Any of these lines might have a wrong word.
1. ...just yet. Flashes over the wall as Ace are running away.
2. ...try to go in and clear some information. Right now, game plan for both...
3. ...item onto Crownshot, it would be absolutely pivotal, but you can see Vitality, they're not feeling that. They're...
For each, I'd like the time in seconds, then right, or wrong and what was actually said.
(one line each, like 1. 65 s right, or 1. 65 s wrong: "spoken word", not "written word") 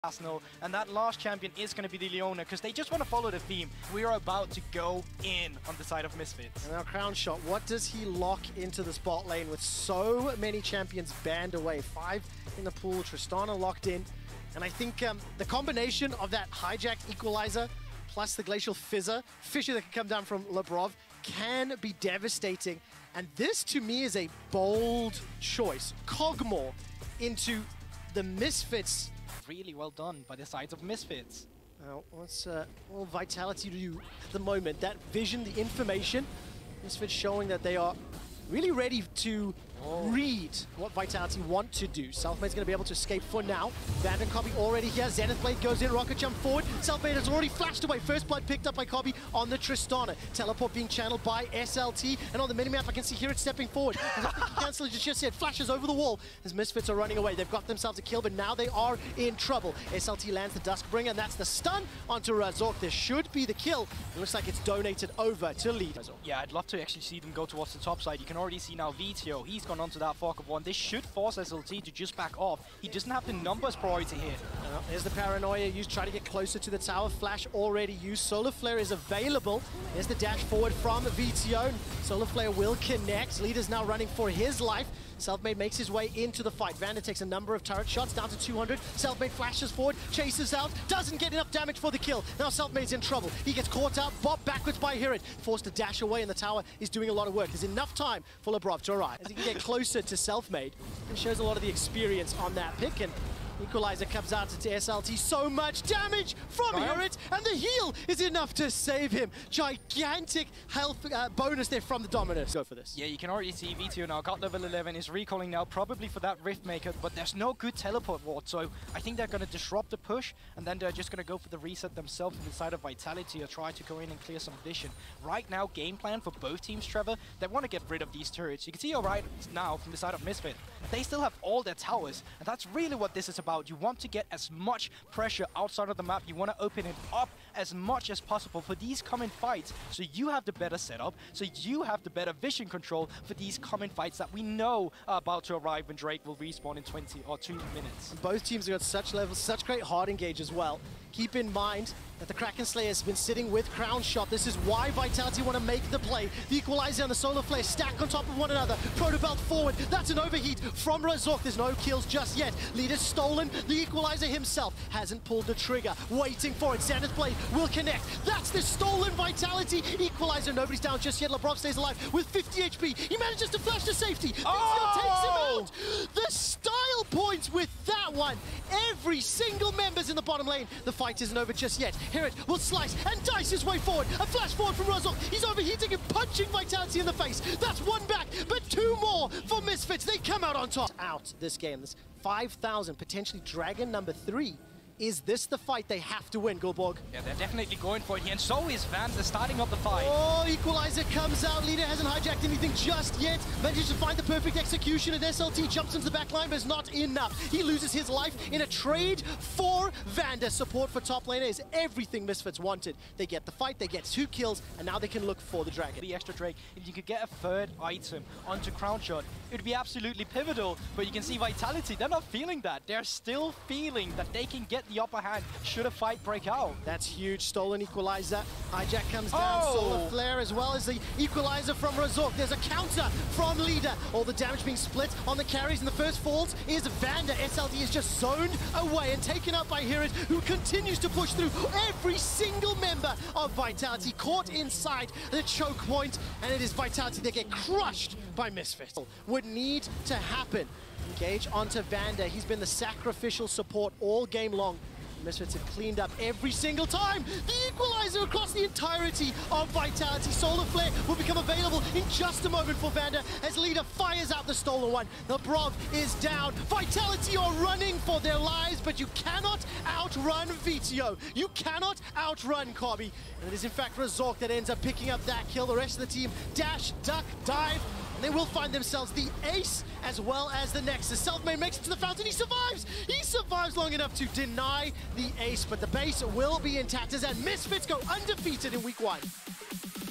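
1. 54 s wrong: "Misfits", not "Ace"
2. 123 s wrong: "vision", not "information"
3. 217 s right.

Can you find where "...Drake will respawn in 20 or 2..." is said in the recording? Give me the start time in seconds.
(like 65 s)
145 s.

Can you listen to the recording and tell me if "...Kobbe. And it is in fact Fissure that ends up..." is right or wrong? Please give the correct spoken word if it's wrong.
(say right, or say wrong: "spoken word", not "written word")
wrong: "Razork", not "Fissure".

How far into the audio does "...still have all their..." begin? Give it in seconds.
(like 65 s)
131 s.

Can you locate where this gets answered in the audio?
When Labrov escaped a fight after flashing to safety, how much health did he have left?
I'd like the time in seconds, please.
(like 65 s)
172 s.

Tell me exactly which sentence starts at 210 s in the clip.
Support for top laner is everything Misfits wanted.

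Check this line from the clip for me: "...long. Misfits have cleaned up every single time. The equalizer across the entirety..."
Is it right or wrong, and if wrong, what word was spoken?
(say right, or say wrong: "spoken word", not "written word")
right.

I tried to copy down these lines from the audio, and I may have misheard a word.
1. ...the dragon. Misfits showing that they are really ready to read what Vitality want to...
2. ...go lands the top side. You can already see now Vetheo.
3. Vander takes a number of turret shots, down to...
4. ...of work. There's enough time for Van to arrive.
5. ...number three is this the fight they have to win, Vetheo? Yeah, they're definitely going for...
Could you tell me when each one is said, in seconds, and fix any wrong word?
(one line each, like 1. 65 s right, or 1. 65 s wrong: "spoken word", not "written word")
1. 35 s wrong: "information", not "dragon"
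2. 67 s wrong: "towards", not "lands"
3. 86 s right
4. 97 s wrong: "Labrov", not "Van"
5. 193 s wrong: "Guldborg", not "Vetheo".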